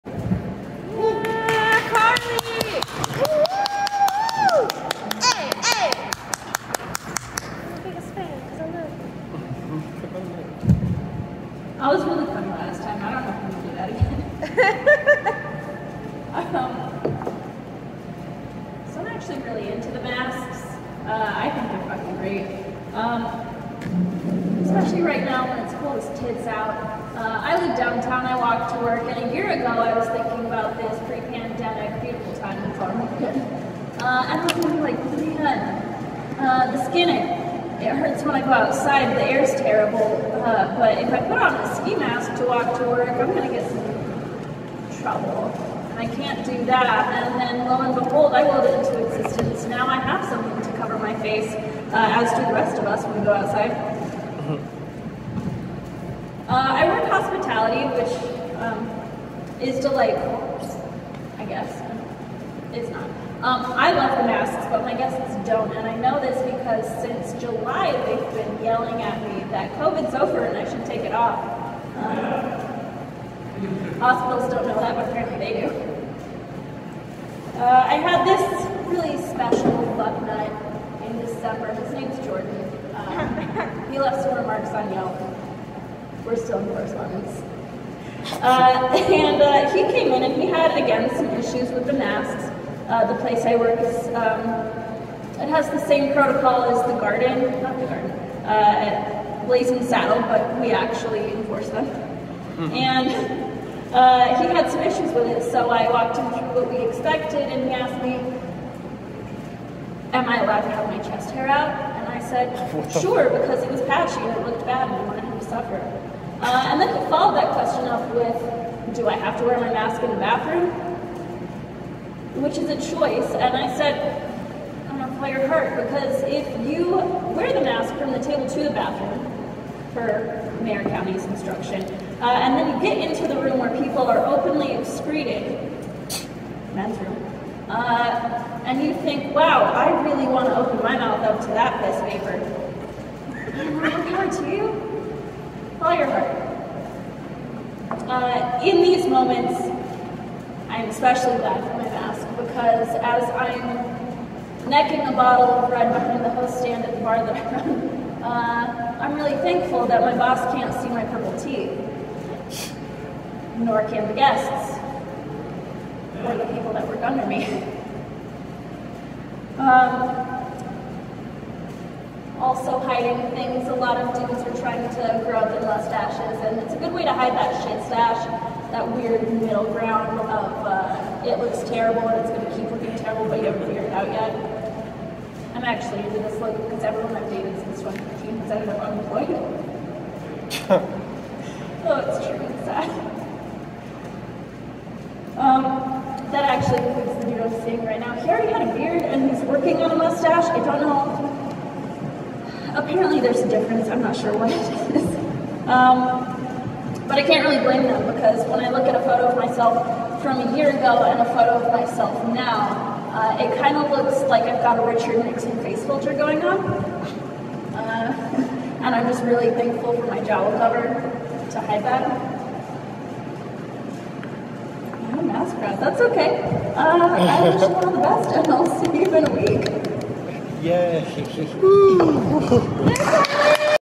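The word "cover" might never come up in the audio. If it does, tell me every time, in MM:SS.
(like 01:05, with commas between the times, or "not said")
00:50, 03:40.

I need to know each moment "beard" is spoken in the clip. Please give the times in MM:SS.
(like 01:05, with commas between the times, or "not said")
03:18.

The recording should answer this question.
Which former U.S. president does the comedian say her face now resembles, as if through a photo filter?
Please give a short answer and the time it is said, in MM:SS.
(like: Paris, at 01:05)
Richard Nixon, at 03:34.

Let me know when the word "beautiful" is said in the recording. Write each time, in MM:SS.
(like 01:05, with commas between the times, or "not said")
00:32.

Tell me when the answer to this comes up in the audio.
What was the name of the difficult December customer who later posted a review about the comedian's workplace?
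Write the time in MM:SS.
01:22.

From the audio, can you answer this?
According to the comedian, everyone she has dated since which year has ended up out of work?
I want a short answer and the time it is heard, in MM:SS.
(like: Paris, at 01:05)
2015, at 03:07.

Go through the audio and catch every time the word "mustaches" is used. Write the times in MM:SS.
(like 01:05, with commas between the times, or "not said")
02:55, 03:19.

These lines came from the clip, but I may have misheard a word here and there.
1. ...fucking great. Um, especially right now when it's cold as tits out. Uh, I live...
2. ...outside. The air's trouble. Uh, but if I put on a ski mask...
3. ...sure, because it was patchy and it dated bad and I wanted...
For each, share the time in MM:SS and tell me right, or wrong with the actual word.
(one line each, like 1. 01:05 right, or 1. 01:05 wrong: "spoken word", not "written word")
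1. 00:21 right
2. 00:38 wrong: "terrible", not "trouble"
3. 01:53 wrong: "looked", not "dated".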